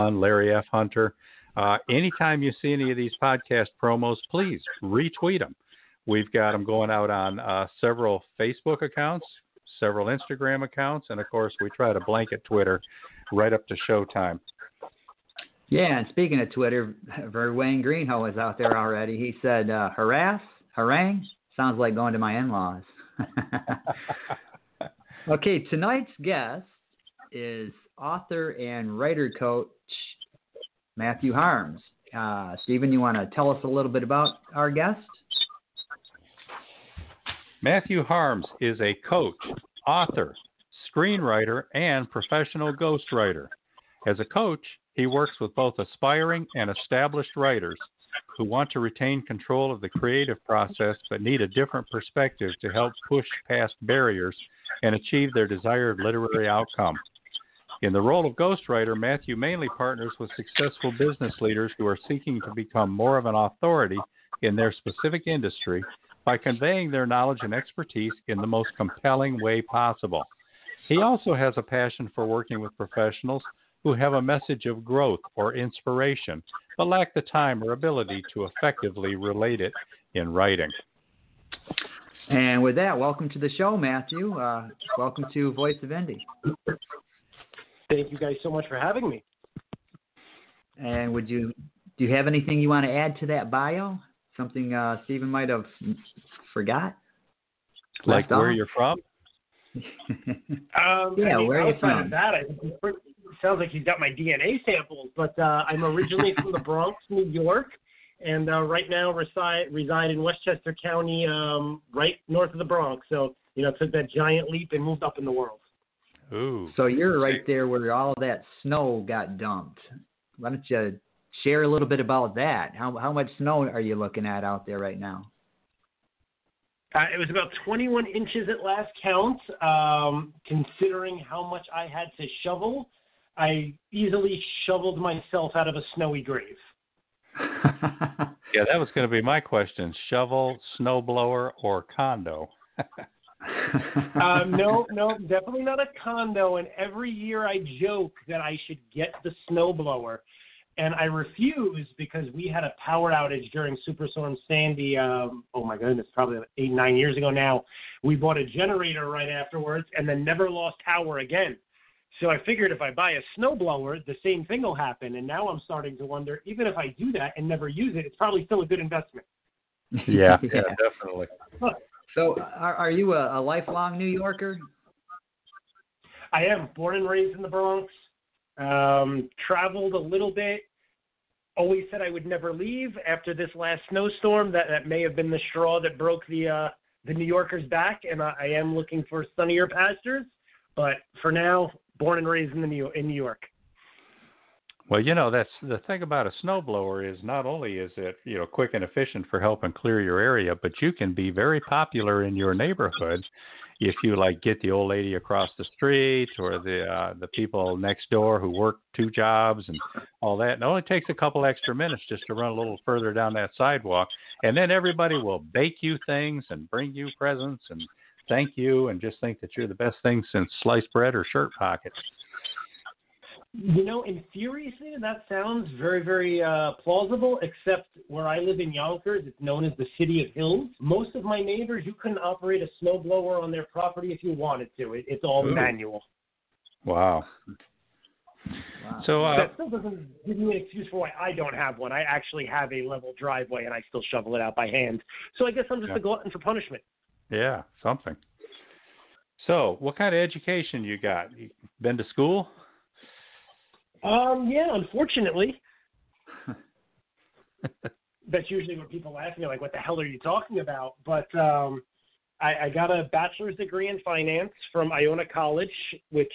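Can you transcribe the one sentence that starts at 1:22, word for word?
And with that, welcome to the show, Matthew.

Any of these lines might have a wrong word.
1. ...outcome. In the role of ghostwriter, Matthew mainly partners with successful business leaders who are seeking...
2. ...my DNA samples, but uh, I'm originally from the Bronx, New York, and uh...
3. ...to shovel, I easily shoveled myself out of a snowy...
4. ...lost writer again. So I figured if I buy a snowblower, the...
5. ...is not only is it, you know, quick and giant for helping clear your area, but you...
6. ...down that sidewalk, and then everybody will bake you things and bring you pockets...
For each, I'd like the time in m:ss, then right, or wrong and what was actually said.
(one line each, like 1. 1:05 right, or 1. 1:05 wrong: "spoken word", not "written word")
1. 0:56 right
2. 1:43 right
3. 2:12 right
4. 2:40 wrong: "power", not "writer"
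5. 3:17 wrong: "efficient", not "giant"
6. 3:33 wrong: "presents", not "pockets".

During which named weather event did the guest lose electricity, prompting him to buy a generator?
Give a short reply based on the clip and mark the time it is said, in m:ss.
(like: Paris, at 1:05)
Superstorm Sandy, at 2:33.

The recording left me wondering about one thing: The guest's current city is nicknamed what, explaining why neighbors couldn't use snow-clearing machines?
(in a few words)
City of Hills.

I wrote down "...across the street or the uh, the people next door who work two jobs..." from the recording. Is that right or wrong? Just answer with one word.
right.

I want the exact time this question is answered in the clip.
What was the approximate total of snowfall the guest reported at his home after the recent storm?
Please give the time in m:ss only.
2:07.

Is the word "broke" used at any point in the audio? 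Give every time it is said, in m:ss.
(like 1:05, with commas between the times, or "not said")
3:05.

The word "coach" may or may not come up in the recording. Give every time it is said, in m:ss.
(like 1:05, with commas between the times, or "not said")
0:29, 0:39, 0:44.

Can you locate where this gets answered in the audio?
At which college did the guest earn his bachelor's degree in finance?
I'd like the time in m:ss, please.
4:24.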